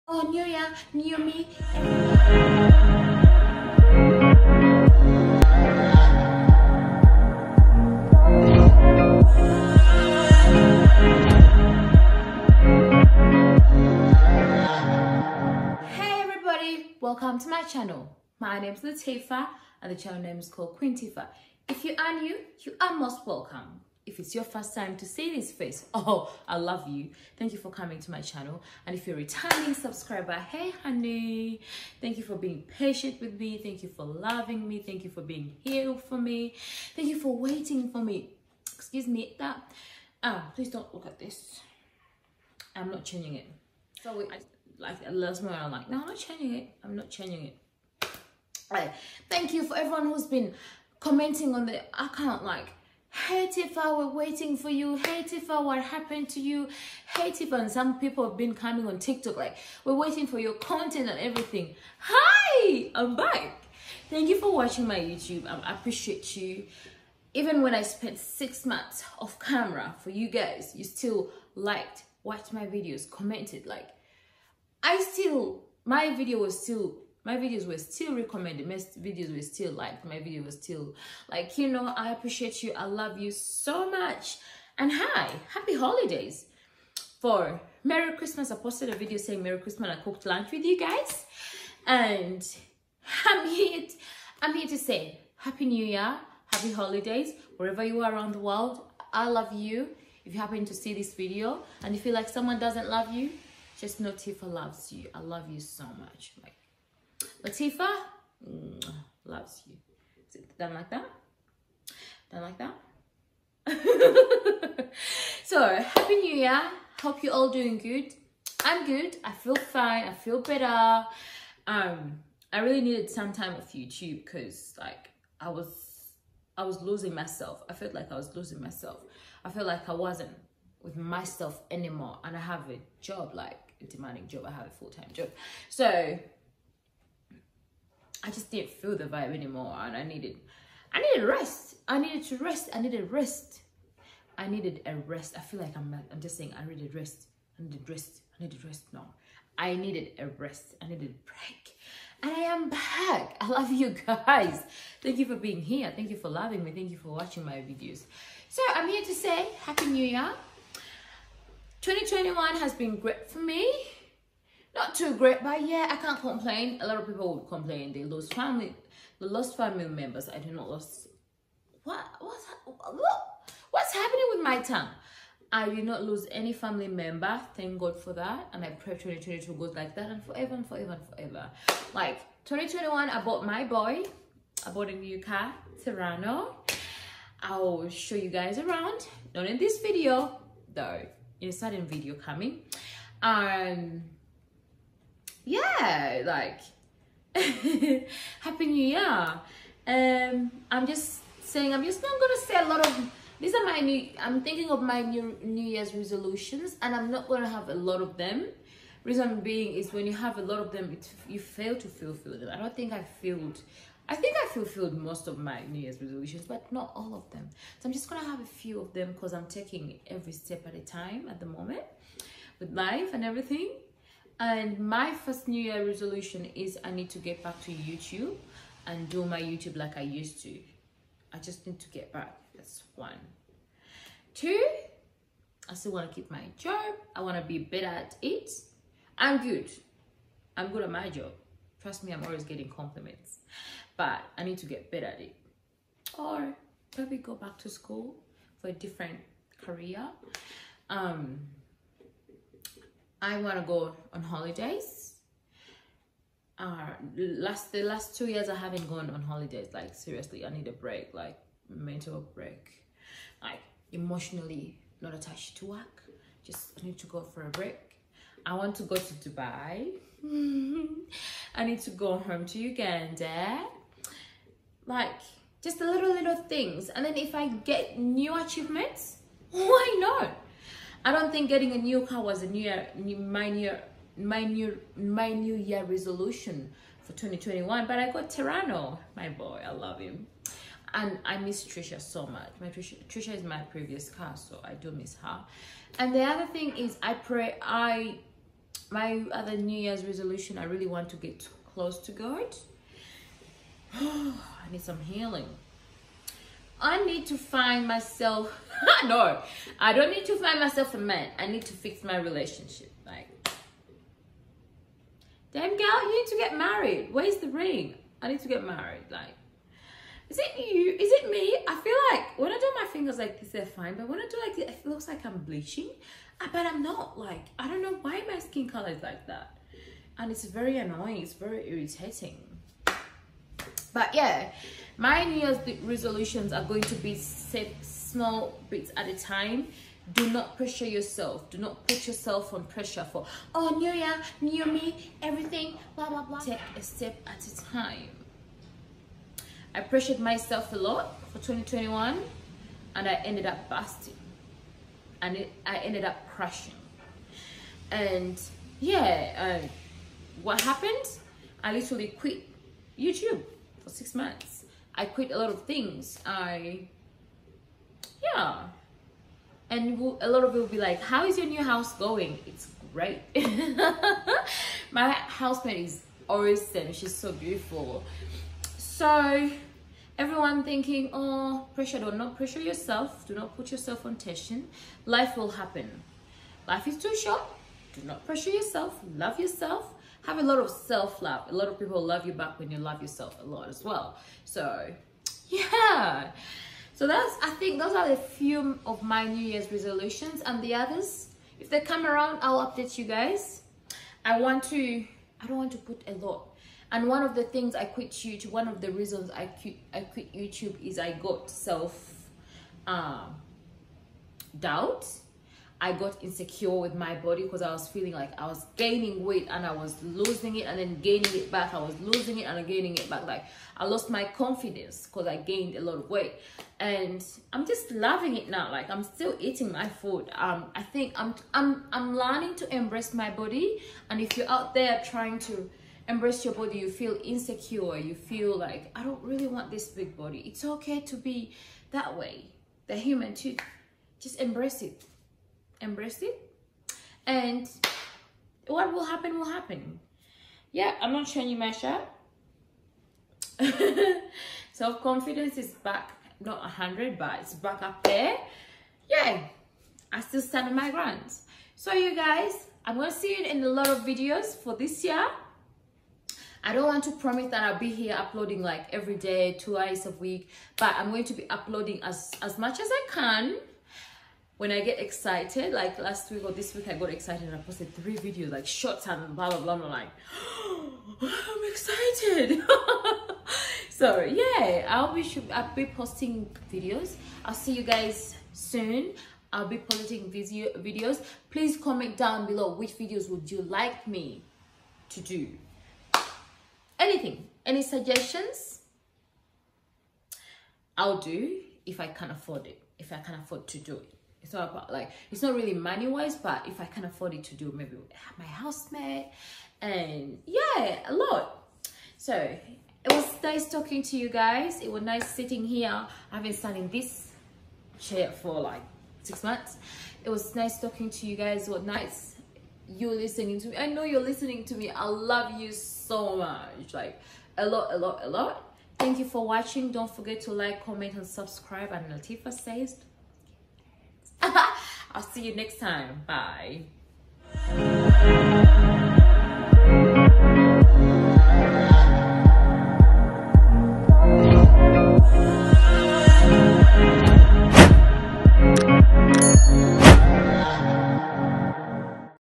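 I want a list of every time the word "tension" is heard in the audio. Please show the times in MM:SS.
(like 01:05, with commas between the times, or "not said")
06:24.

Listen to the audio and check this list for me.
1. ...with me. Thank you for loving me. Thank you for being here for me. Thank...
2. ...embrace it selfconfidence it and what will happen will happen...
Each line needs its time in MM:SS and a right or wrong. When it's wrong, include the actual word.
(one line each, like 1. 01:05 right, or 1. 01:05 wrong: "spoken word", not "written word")
1. 00:33 right
2. 07:24 wrong: "embrace", not "selfconfidence".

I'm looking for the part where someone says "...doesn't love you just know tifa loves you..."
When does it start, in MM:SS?
01:42.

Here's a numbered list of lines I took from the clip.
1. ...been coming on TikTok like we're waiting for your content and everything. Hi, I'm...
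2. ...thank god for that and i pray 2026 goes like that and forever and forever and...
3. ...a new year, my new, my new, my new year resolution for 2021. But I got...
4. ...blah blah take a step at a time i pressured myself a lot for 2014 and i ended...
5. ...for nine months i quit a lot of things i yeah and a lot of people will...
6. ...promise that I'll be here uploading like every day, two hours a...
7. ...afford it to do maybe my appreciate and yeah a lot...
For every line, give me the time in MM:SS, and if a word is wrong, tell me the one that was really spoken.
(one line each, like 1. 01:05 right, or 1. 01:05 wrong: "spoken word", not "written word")
1. 00:58 right
2. 02:57 wrong: "2022", not "2026"
3. 04:42 right
4. 05:46 wrong: "2021", not "2014"
5. 06:03 wrong: "six", not "nine"
6. 07:47 right
7. 08:27 wrong: "housemate", not "appreciate".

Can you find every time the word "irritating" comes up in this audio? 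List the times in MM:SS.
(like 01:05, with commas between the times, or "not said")
05:31.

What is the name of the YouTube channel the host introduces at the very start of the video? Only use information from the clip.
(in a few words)
KqinTifah.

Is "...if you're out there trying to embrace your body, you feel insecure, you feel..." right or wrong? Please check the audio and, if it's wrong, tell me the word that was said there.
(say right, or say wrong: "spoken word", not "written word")
right.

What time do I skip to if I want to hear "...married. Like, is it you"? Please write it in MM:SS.
05:18.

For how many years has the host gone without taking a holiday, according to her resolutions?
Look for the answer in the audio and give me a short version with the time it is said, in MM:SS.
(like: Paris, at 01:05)
2, at 04:17.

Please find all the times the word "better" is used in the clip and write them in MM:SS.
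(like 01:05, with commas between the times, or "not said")
02:00, 03:57, 04:04.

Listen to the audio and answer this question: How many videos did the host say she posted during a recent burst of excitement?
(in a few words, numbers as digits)
3.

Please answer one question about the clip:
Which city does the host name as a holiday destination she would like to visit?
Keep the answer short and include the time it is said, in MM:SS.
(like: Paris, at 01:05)
Dubai, at 04:29.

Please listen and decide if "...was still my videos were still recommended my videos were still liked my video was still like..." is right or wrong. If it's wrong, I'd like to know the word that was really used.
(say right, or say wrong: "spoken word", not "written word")
right.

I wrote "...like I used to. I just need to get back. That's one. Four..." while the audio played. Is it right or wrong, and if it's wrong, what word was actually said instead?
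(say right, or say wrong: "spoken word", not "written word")
wrong: "Two", not "Four".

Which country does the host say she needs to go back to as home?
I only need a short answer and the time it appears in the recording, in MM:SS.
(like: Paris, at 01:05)
Uganda, at 04:32.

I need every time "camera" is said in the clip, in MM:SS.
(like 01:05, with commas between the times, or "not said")
01:09.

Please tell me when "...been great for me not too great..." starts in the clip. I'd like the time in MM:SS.
02:42.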